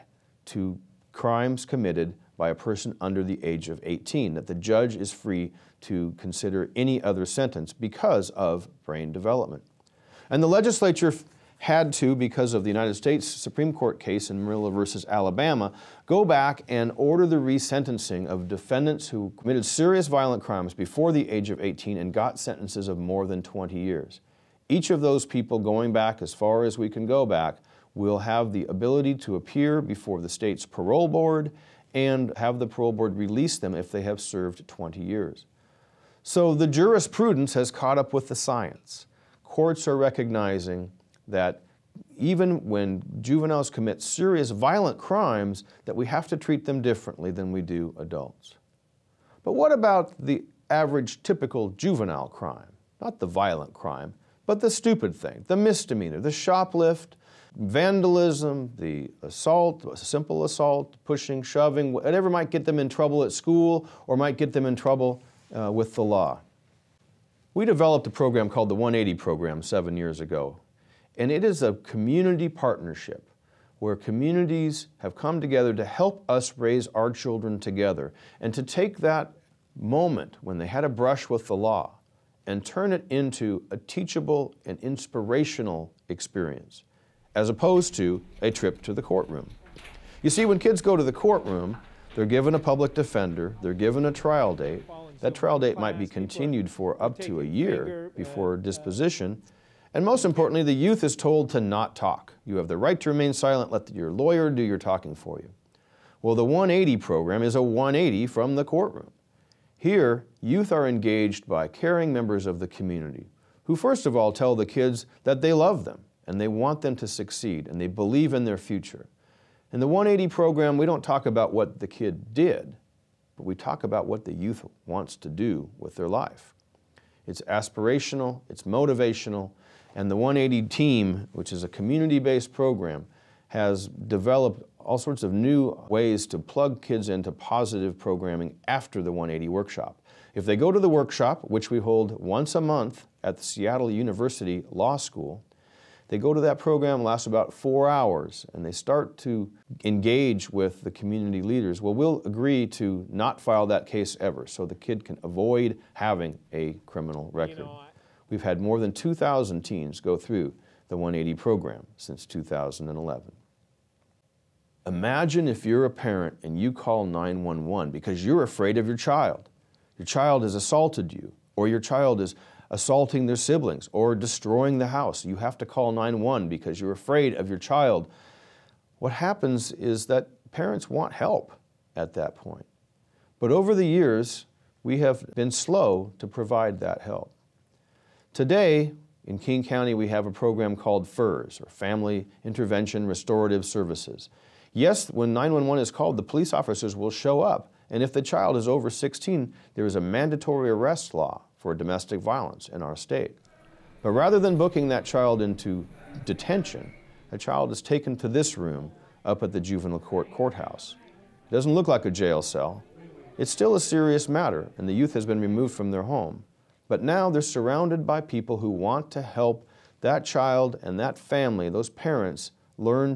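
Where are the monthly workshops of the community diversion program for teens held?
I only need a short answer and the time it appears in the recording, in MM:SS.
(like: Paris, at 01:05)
Seattle University Law School, at 02:23.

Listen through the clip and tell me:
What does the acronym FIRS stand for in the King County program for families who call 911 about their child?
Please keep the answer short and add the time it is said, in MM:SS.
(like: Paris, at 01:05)
Family Intervention Restorative Services, at 03:11.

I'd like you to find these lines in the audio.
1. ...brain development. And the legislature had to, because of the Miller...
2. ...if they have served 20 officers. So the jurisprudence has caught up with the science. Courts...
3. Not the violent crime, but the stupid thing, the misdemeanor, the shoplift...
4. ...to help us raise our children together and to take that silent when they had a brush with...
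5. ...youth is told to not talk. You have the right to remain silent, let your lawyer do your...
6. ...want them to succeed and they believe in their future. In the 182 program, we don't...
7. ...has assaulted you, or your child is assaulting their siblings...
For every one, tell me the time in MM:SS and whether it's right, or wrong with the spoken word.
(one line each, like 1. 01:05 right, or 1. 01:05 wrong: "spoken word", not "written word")
1. 00:08 wrong: "United", not "Miller"
2. 00:33 wrong: "years", not "officers"
3. 00:53 right
4. 01:15 wrong: "moment", not "silent"
5. 01:40 right
6. 01:56 wrong: "180", not "182"
7. 02:50 right.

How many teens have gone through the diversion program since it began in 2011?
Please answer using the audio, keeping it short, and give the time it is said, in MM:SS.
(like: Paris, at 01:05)
More than 2,000, at 02:38.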